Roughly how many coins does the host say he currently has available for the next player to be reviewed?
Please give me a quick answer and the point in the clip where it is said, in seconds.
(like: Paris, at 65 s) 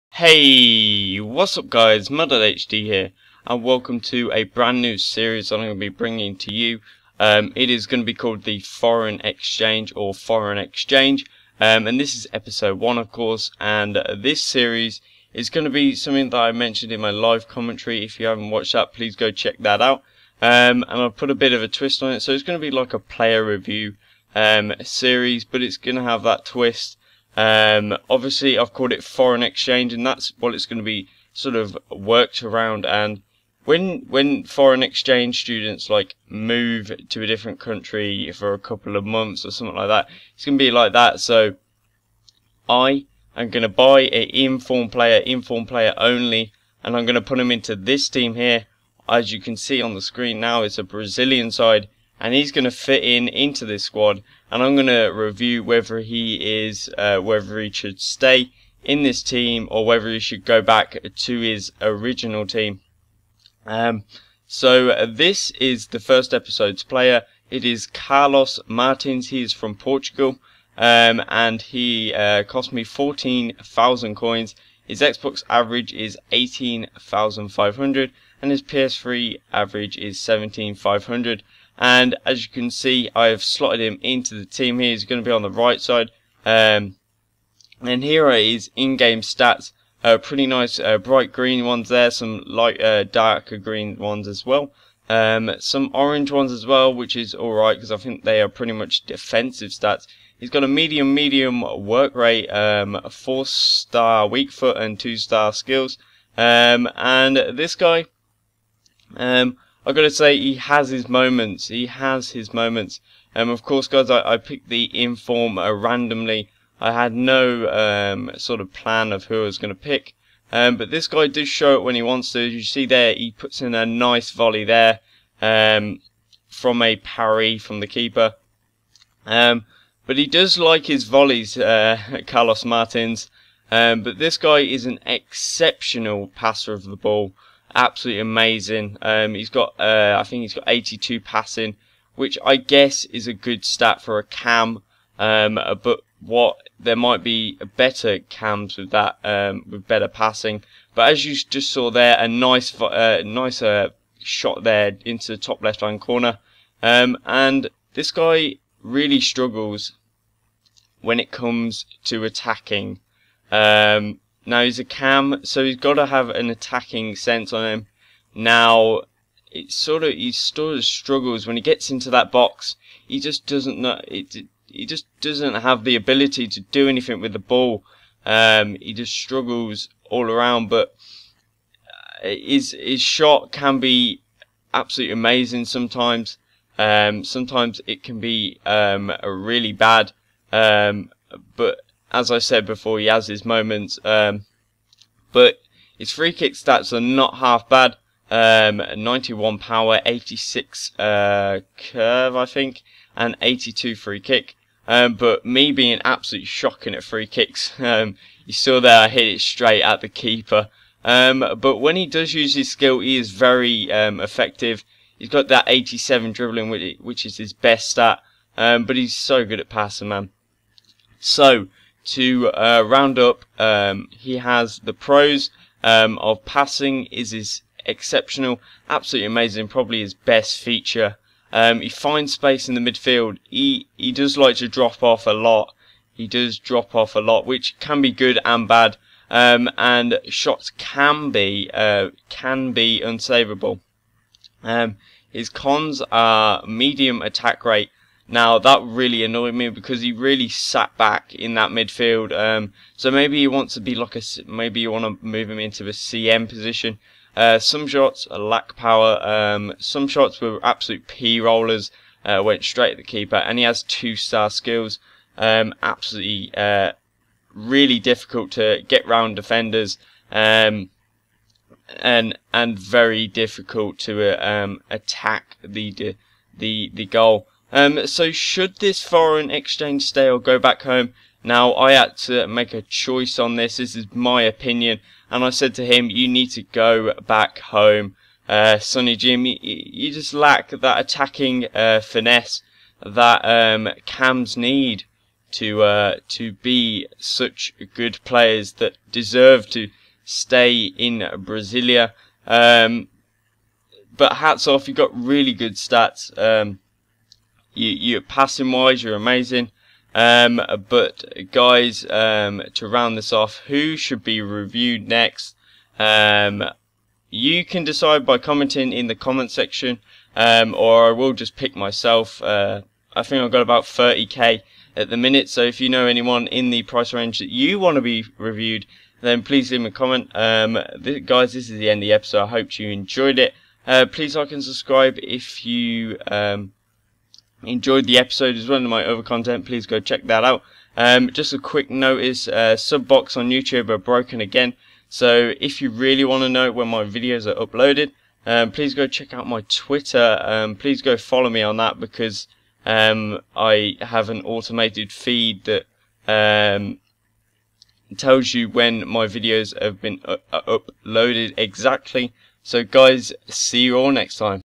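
30k, at 323 s.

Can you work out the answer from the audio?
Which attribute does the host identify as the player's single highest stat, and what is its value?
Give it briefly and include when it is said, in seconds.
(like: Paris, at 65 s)
87 dribbling, at 215 s.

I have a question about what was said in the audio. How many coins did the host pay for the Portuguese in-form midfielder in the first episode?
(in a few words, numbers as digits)
14,000.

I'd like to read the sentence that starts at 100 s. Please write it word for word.
He's got a medium, medium work rate, um, four star weak foot and two star skills.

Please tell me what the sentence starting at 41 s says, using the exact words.
So I am going to buy an inform player, inform player only, and I'm going to put him into this team here.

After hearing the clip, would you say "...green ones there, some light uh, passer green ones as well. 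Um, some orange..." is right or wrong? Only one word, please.
wrong.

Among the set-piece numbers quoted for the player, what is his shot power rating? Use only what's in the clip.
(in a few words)
91.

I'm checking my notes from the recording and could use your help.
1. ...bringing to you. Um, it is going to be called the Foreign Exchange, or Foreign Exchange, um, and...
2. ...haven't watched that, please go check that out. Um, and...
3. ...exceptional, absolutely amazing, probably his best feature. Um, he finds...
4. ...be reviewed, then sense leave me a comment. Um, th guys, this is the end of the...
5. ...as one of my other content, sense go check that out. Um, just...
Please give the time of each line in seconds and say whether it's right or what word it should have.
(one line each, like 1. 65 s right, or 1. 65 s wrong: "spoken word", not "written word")
1. 5 s right
2. 18 s right
3. 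227 s right
4. 328 s wrong: "please", not "sense"
5. 338 s wrong: "please", not "sense".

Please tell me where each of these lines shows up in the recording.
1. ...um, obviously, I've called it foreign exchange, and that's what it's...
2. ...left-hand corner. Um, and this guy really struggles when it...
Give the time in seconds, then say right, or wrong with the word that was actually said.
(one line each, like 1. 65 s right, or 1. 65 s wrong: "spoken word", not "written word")
1. 27 s right
2. 155 s right.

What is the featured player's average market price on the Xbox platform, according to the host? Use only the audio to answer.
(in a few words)
18,500.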